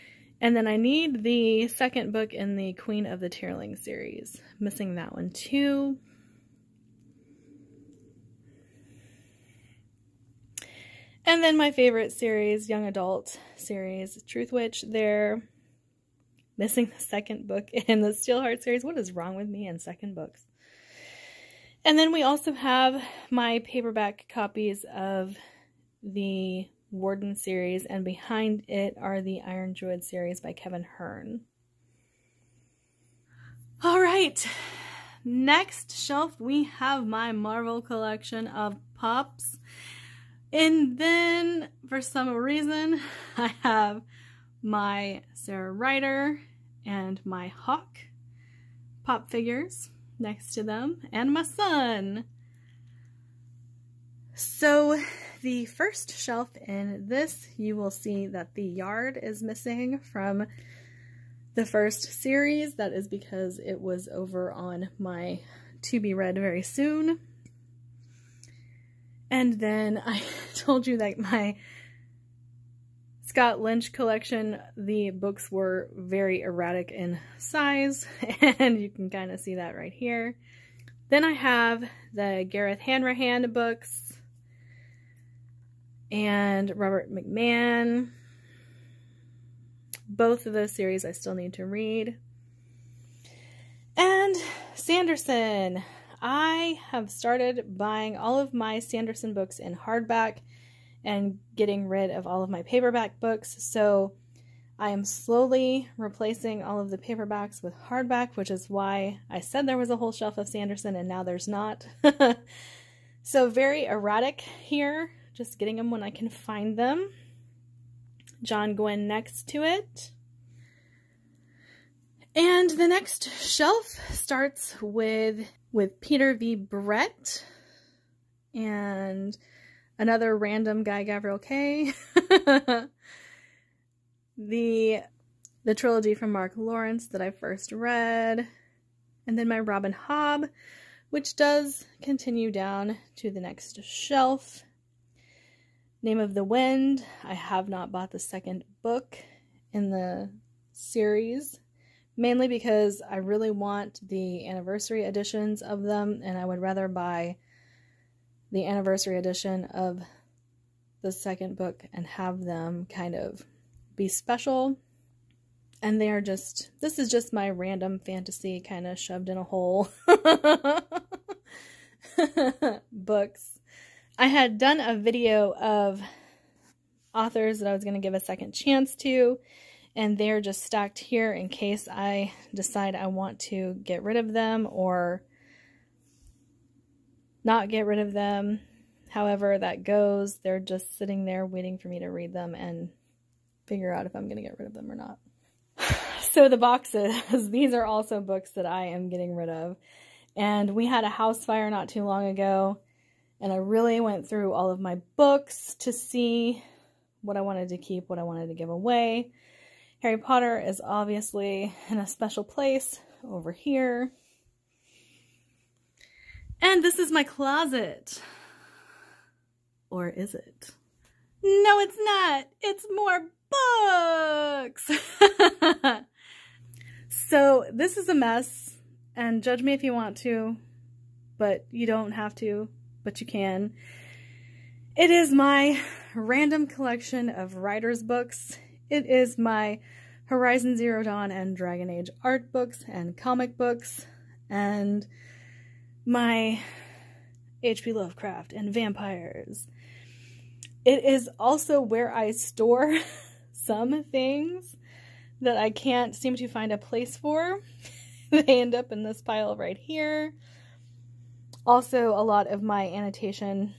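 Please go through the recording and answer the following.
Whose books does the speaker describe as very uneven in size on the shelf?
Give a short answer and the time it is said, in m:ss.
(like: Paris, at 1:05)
Scott Lynch, at 1:13.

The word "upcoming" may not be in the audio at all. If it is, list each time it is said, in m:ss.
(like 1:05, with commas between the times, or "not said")
not said.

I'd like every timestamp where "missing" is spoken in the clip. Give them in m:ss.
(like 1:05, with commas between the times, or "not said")
0:04, 0:16, 0:59.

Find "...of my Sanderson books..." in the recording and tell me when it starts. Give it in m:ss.
1:38.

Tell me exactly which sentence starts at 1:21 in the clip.
Then I have the Gareth Hanrahan books and Robert McMahon.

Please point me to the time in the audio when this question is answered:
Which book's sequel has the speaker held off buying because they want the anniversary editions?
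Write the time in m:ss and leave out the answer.
2:26.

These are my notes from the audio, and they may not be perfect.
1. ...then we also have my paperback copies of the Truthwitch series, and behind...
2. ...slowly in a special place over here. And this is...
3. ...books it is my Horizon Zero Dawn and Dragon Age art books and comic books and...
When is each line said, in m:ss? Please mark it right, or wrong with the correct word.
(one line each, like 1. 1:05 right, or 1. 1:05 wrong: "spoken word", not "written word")
1. 0:21 wrong: "Warden", not "Truthwitch"
2. 3:30 wrong: "obviously", not "slowly"
3. 3:58 right.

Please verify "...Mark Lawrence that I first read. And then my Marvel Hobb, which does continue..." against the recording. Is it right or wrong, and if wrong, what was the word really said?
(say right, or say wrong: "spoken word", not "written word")
wrong: "Robin", not "Marvel".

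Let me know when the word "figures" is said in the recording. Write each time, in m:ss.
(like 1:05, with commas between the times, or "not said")
0:49, 3:13.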